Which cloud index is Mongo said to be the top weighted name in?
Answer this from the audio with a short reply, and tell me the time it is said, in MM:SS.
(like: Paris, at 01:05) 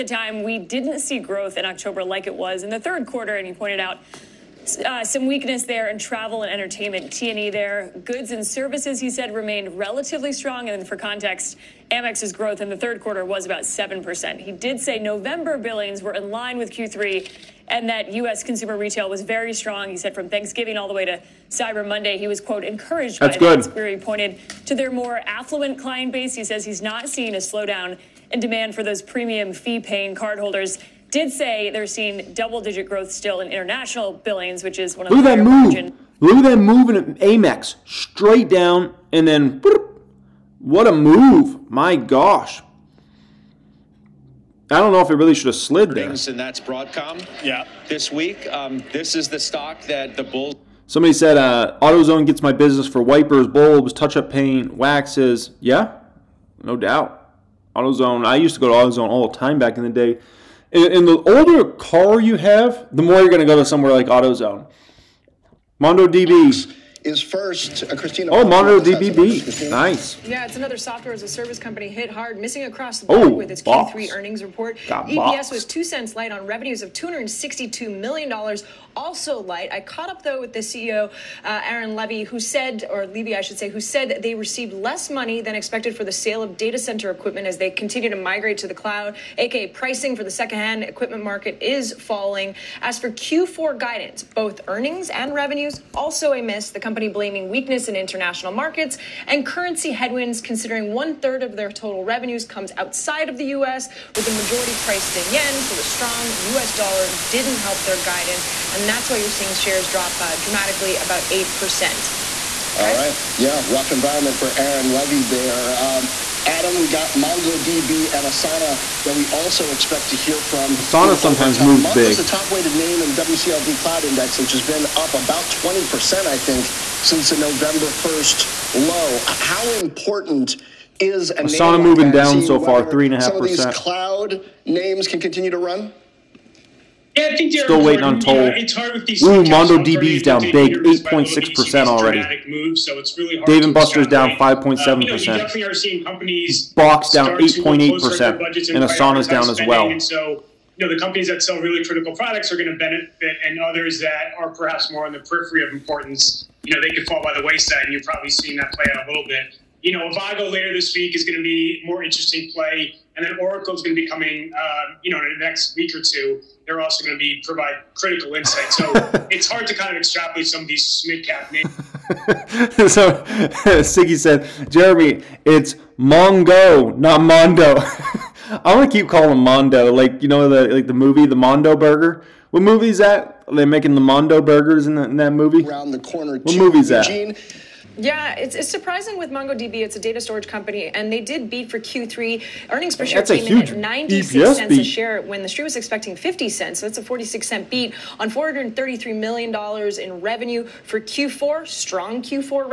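WCLD Cloud Index, at 02:03.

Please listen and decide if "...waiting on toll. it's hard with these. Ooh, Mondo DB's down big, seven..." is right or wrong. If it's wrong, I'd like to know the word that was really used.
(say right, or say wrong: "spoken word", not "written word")
wrong: "eight", not "seven".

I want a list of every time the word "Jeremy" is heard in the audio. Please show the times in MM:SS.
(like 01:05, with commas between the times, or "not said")
02:54.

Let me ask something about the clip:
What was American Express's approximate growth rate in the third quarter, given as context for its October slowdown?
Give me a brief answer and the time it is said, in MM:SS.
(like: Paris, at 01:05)
7%, at 00:13.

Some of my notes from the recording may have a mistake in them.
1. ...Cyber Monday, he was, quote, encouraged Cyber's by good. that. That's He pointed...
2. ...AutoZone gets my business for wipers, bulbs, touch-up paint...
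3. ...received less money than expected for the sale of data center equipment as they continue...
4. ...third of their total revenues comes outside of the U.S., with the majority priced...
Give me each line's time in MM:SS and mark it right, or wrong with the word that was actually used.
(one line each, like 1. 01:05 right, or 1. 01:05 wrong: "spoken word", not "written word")
1. 00:21 wrong: "That", not "Cyber"
2. 00:51 right
3. 01:24 right
4. 01:41 right.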